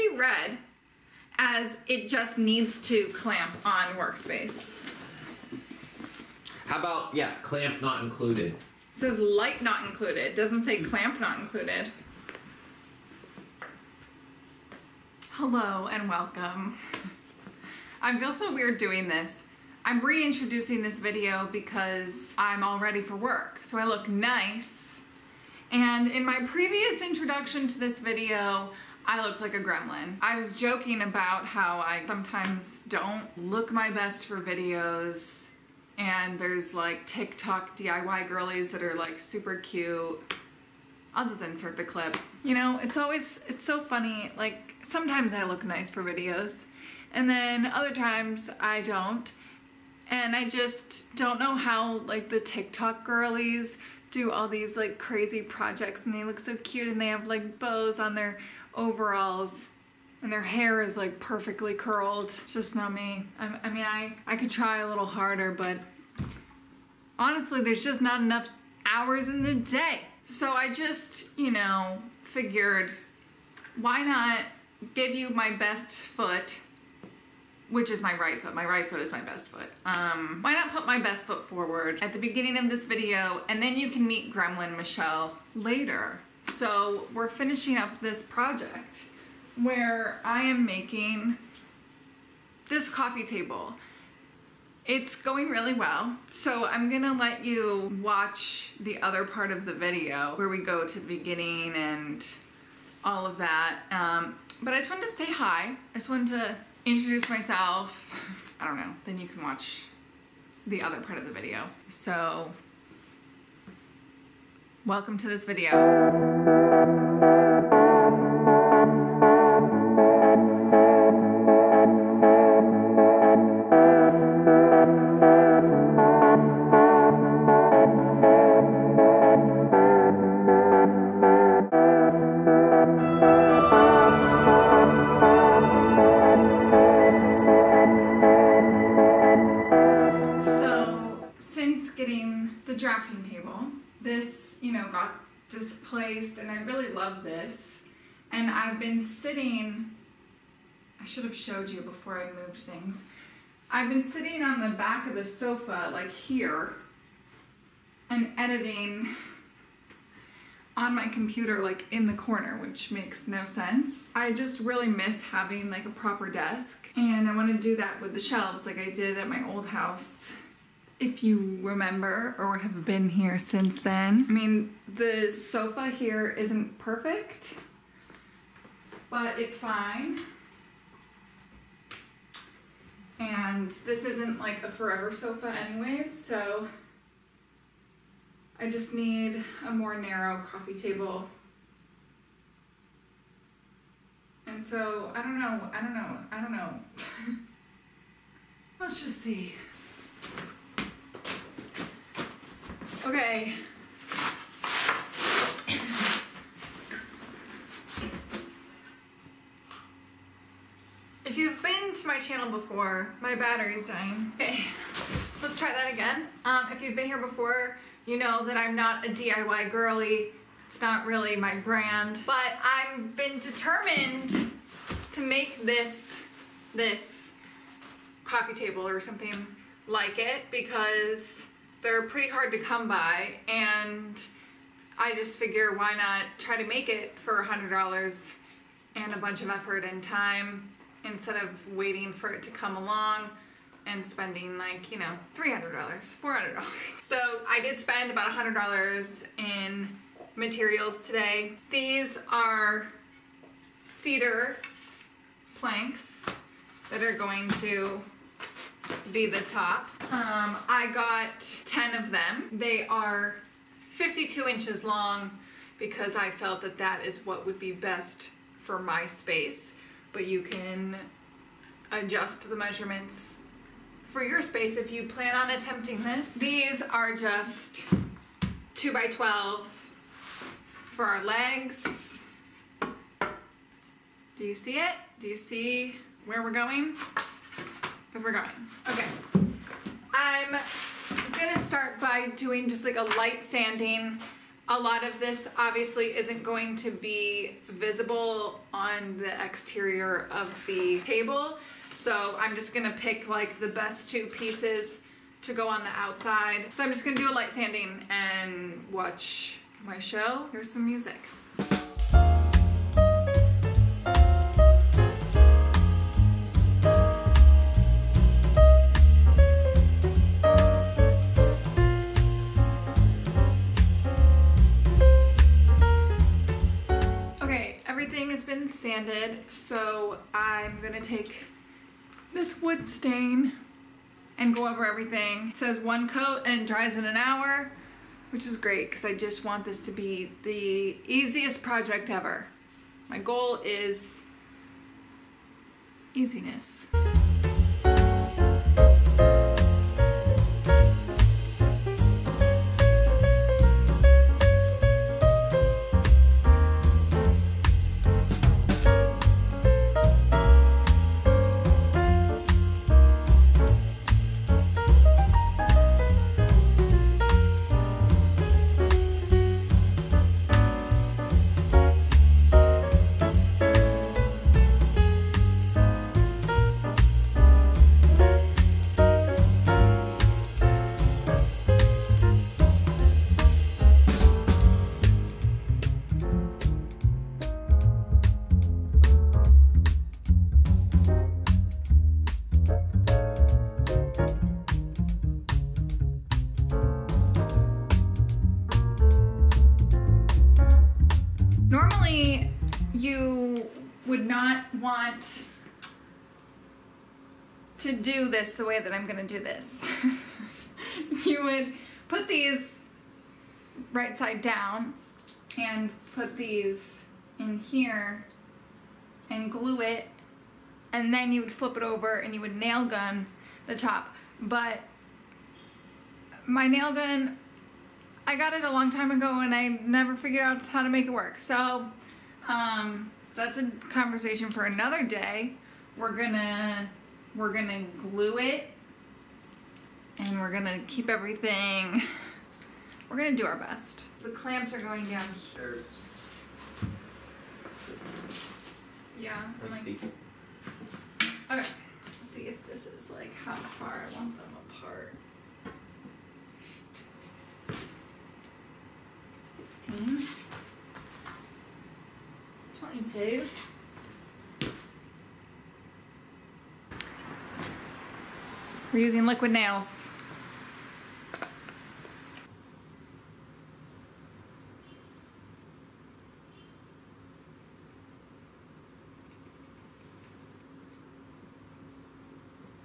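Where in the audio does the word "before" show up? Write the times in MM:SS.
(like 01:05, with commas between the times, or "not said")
02:31, 03:32, 03:37.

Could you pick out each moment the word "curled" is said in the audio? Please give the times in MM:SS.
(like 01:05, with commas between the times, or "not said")
01:01.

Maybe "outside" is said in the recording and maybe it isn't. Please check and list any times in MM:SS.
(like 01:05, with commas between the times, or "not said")
05:05.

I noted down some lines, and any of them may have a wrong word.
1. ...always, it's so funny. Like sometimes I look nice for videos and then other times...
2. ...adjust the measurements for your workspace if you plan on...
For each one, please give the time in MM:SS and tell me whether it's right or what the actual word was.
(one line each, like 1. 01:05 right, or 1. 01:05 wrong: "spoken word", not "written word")
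1. 00:42 right
2. 04:31 wrong: "space", not "workspace".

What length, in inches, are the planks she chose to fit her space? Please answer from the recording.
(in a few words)
52 inches.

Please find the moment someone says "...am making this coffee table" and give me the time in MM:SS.
01:30.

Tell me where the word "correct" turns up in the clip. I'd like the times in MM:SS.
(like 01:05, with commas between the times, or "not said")
not said.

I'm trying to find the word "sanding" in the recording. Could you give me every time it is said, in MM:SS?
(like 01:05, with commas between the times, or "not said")
04:53, 05:07.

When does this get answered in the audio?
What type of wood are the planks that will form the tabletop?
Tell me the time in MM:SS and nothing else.
04:13.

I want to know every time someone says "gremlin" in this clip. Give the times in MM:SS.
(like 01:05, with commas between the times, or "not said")
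00:29, 01:24.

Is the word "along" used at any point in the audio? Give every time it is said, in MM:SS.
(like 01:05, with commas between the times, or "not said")
04:02.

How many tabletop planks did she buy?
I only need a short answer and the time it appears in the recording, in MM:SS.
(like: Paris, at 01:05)
10, at 04:21.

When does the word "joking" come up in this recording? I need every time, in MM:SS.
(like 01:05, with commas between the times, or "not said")
00:30.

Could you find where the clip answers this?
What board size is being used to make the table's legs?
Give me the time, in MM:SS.
04:38.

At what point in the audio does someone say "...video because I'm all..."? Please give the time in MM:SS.
00:20.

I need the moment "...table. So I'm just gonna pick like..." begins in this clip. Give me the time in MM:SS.
05:01.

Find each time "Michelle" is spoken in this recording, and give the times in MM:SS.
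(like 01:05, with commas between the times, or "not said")
01:24.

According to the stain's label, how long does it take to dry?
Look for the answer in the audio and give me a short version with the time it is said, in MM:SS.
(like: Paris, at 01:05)
an hour, at 05:37.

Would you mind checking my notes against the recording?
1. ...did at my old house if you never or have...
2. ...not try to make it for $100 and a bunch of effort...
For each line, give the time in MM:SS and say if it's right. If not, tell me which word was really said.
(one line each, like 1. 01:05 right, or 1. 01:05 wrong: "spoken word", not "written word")
1. 02:48 wrong: "remember", not "never"
2. 03:55 right.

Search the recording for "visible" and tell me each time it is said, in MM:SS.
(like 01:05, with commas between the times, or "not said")
04:57.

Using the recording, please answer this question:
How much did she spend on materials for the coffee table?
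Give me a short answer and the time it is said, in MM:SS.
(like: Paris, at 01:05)
$100, at 04:08.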